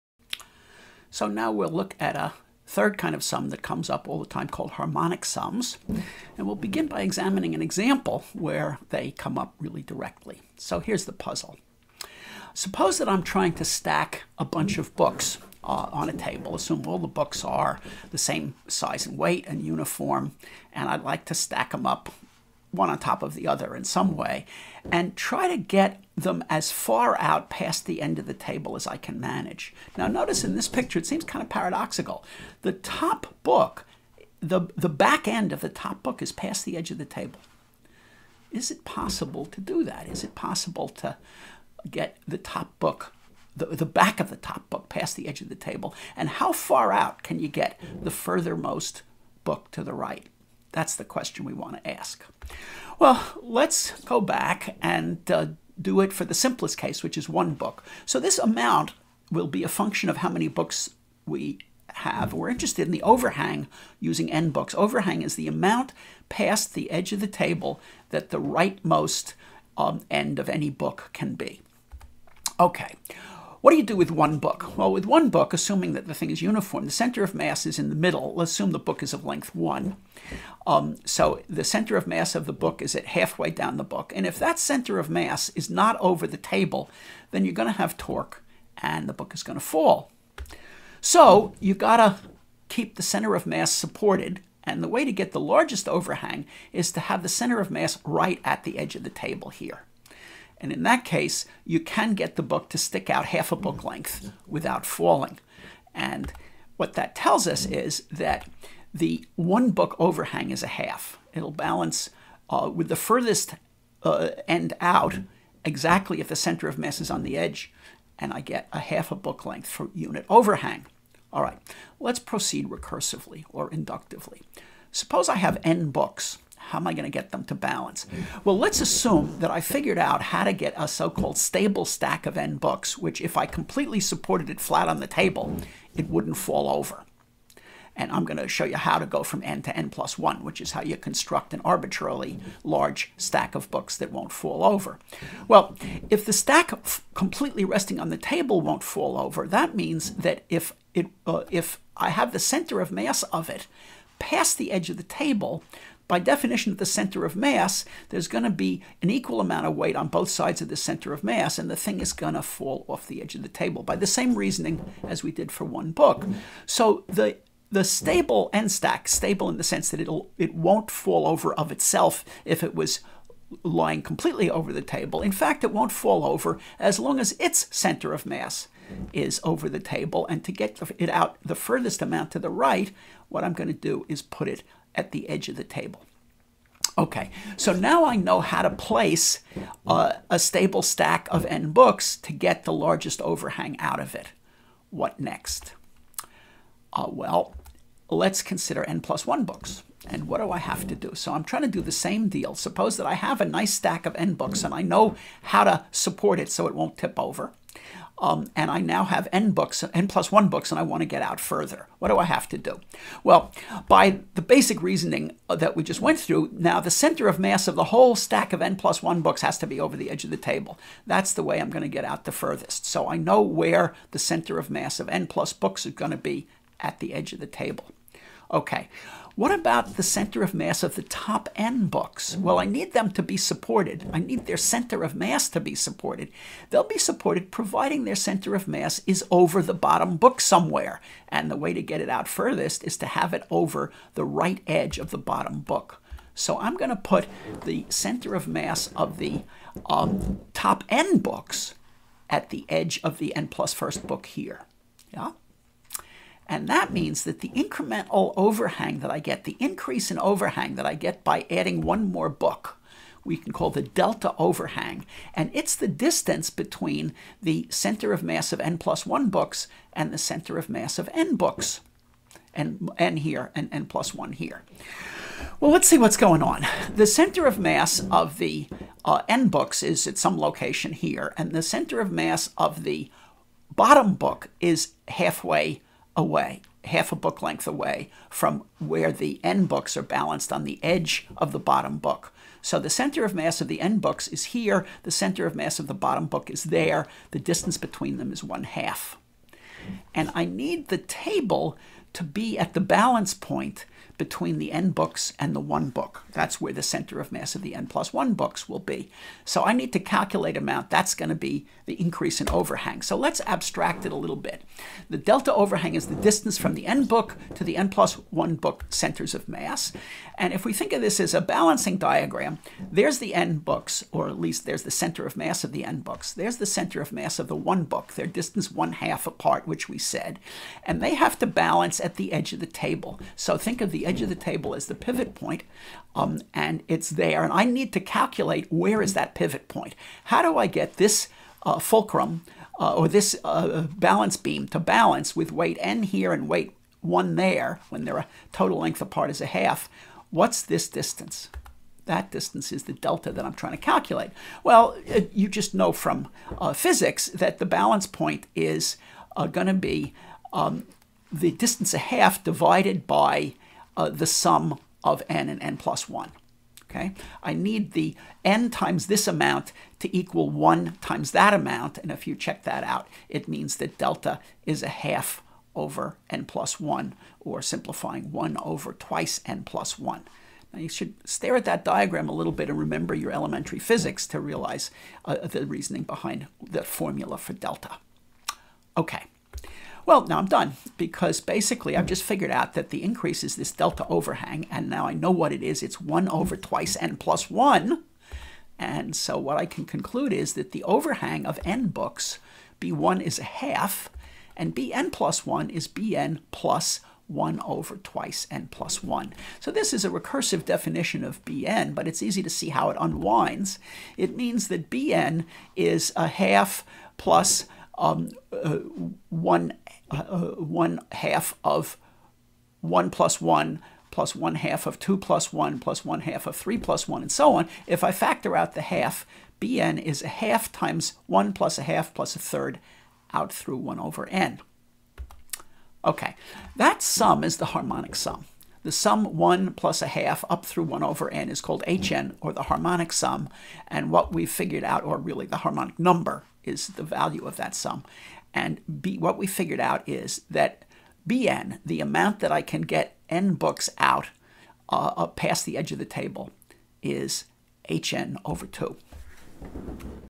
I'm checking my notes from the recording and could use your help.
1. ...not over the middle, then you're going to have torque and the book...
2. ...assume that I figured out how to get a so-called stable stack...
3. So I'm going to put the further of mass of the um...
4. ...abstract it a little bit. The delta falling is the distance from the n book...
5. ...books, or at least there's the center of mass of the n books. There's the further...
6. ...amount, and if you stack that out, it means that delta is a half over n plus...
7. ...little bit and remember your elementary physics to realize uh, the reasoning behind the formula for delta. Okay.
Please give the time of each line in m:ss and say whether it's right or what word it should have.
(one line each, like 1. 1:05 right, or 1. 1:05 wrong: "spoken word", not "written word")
1. 1:25 wrong: "table", not "middle"
2. 2:08 right
3. 4:06 wrong: "center", not "further"
4. 5:13 wrong: "overhang", not "falling"
5. 5:23 wrong: "center", not "further"
6. 6:11 wrong: "check", not "stack"
7. 6:22 right.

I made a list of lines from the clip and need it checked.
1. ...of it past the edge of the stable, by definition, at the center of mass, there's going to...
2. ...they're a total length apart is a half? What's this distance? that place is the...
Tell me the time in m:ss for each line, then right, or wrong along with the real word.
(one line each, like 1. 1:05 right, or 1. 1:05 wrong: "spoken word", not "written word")
1. 2:33 wrong: "table", not "stable"
2. 5:48 wrong: "distance", not "place".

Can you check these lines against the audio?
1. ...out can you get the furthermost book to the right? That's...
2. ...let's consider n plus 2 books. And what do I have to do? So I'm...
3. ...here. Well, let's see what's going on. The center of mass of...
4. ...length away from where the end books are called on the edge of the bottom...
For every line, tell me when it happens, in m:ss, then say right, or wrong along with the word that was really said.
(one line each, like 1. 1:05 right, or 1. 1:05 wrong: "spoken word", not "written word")
1. 0:46 right
2. 3:18 wrong: "1", not "2"
3. 4:34 right
4. 4:47 wrong: "balanced", not "called".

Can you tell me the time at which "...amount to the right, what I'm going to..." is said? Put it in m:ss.
3:02.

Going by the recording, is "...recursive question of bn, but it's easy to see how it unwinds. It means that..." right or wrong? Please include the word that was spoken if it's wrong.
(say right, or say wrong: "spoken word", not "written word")
wrong: "definition", not "question".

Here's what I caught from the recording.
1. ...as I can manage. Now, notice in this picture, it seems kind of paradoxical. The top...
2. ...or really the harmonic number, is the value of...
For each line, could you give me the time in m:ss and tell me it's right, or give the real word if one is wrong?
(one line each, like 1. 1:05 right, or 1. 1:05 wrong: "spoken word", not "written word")
1. 0:28 right
2. 7:25 right.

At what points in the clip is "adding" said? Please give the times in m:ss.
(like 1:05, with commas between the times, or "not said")
4:21.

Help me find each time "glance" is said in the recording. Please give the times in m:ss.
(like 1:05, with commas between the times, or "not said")
not said.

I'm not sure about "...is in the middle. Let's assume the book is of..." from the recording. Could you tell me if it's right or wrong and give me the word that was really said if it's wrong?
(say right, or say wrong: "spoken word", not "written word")
right.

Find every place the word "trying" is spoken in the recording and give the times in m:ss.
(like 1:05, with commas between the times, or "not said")
0:13, 3:21, 5:53.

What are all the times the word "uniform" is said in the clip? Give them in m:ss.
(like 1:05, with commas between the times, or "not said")
0:19, 1:16.